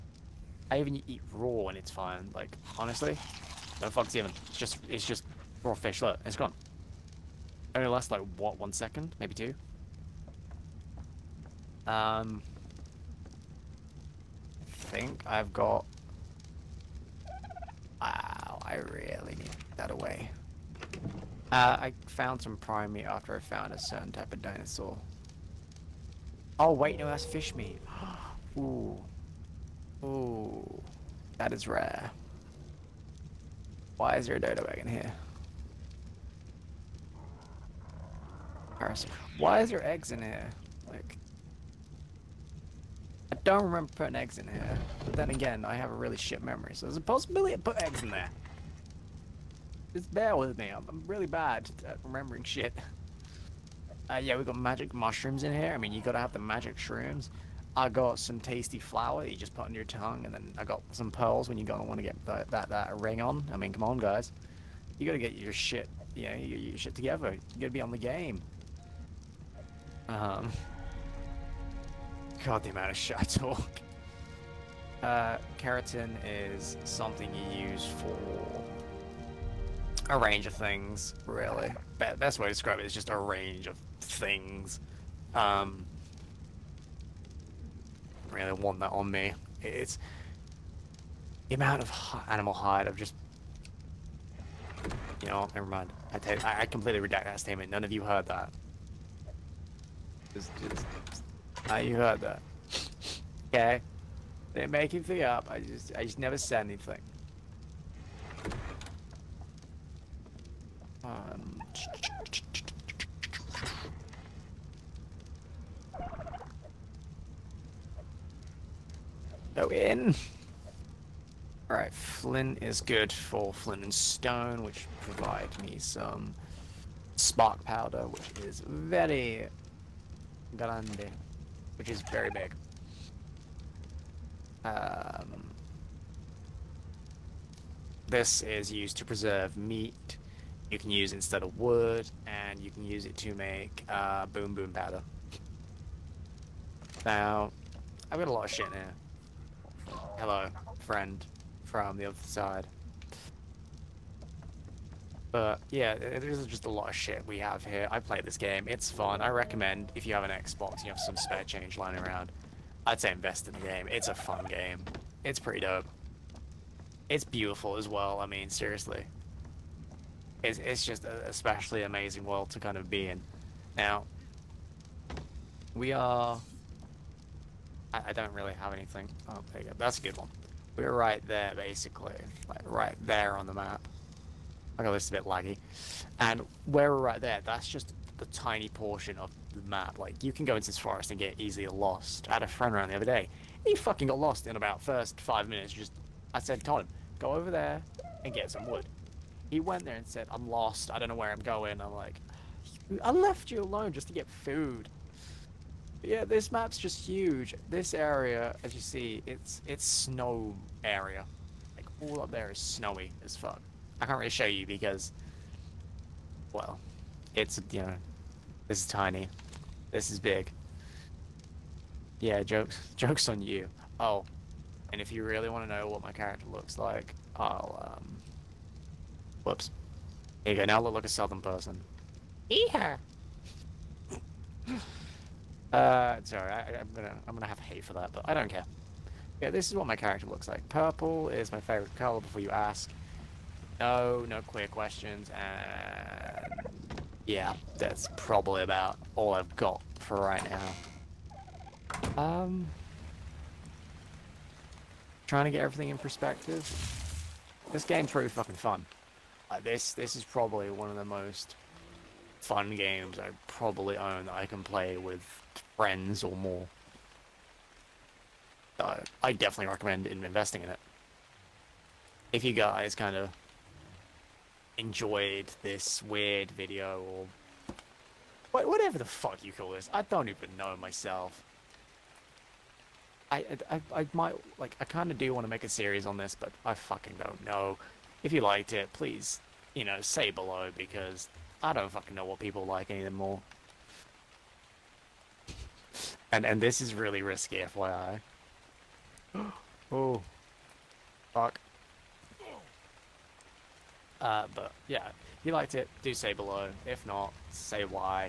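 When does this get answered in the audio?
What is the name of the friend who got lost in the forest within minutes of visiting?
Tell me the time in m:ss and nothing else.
3:16.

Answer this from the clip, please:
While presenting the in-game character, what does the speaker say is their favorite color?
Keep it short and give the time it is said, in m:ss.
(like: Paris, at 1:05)
Purple, at 4:00.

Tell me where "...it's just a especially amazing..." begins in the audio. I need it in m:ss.
2:50.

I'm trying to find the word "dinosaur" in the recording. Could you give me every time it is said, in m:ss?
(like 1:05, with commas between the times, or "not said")
0:24.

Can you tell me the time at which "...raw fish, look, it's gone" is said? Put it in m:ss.
0:05.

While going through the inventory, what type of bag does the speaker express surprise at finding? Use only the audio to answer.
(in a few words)
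dodo bag.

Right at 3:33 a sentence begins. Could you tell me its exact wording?
I can't really show you because, well, it's, you know, this is tiny.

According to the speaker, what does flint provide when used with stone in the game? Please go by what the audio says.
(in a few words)
spark powder.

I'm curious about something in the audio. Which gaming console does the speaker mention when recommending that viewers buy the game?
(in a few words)
Xbox.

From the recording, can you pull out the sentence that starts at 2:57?
I, I don't really have anything.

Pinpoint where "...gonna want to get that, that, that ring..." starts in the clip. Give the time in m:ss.
1:01.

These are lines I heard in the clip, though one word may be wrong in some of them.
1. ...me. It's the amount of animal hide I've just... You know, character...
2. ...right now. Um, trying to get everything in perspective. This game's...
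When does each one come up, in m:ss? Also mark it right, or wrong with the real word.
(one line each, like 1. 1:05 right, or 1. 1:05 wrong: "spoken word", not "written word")
1. 1:29 wrong: "never", not "character"
2. 4:10 right.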